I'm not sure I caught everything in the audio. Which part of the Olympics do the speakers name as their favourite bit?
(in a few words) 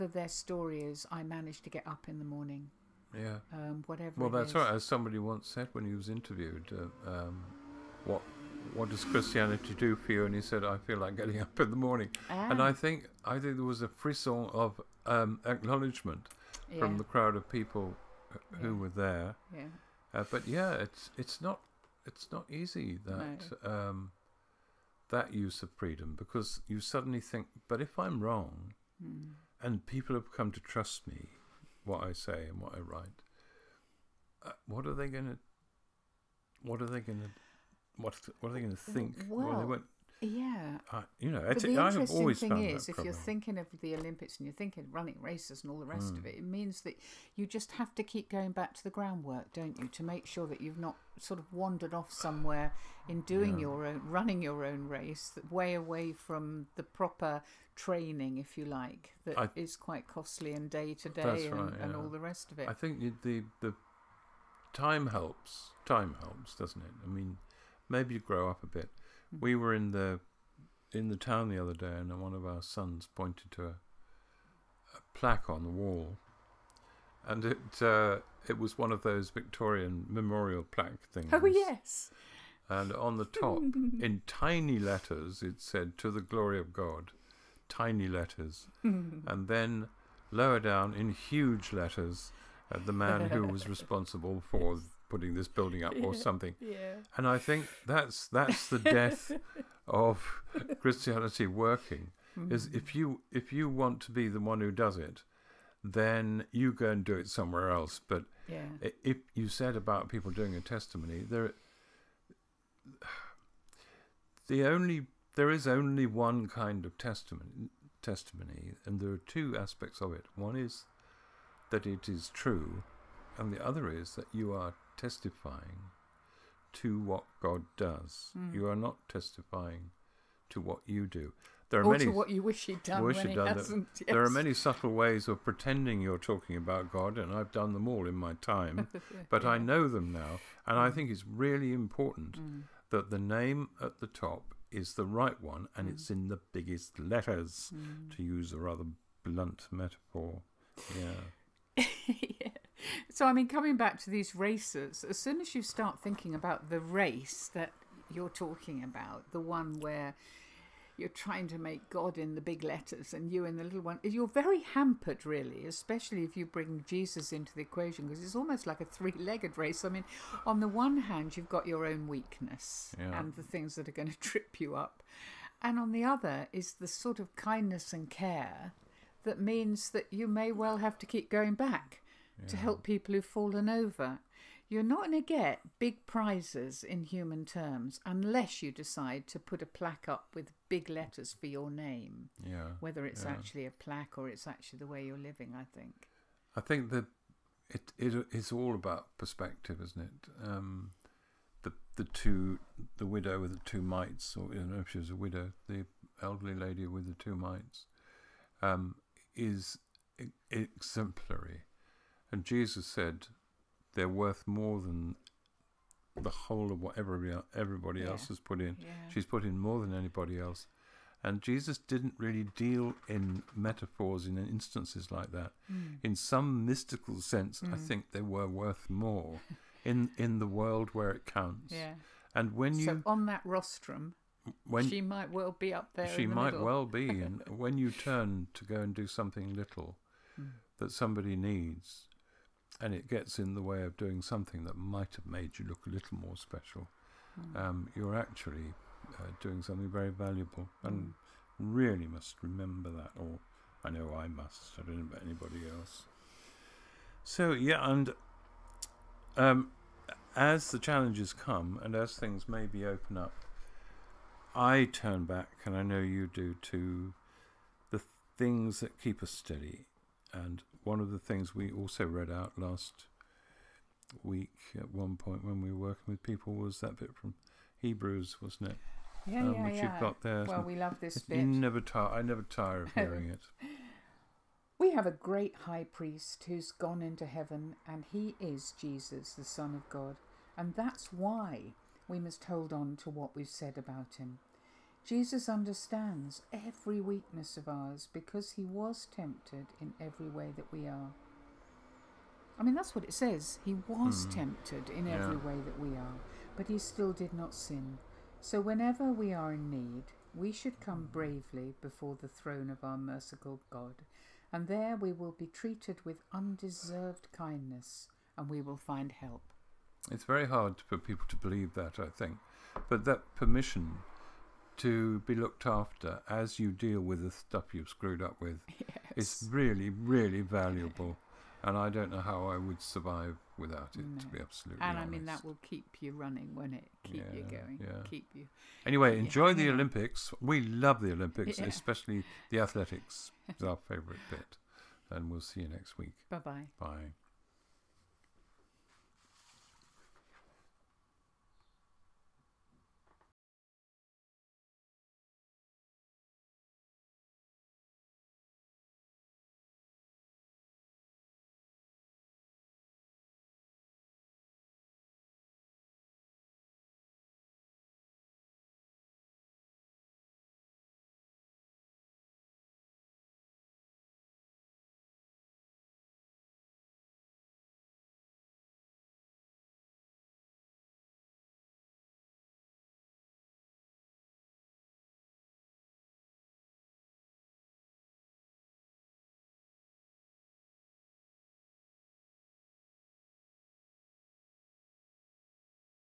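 Athletics.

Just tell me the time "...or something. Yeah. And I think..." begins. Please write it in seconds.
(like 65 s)
96 s.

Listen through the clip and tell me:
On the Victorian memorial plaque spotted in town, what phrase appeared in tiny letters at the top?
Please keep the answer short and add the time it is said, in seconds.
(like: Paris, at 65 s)
To the glory of God, at 85 s.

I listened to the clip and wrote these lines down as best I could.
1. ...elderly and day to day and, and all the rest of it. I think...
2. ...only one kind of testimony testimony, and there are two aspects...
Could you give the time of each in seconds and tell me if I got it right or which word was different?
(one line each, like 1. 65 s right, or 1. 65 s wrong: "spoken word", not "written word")
1. 60 s wrong: "costly", not "elderly"
2. 115 s right.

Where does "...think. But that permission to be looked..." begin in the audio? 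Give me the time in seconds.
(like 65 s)
322 s.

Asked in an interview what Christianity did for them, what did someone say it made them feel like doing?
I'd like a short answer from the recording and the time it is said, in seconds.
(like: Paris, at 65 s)
Getting up in the morning, at 11 s.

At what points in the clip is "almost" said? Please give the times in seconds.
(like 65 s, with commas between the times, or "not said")
168 s.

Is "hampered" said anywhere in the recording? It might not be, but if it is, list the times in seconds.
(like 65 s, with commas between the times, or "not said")
164 s.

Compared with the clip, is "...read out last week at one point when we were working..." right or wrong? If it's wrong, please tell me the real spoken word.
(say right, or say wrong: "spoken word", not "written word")
right.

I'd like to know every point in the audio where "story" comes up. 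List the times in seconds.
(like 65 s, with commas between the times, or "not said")
0 s.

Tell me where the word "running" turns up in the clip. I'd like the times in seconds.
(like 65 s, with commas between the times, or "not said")
44 s, 54 s, 336 s.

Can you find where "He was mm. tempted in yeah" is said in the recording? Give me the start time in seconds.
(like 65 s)
303 s.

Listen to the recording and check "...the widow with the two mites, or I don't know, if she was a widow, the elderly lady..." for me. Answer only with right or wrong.
right.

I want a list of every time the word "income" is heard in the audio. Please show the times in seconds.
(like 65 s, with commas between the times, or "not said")
not said.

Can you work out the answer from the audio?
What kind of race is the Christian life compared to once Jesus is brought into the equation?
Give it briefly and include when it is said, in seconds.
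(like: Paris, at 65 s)
Three legged race, at 168 s.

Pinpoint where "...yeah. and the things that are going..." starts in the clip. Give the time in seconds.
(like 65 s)
172 s.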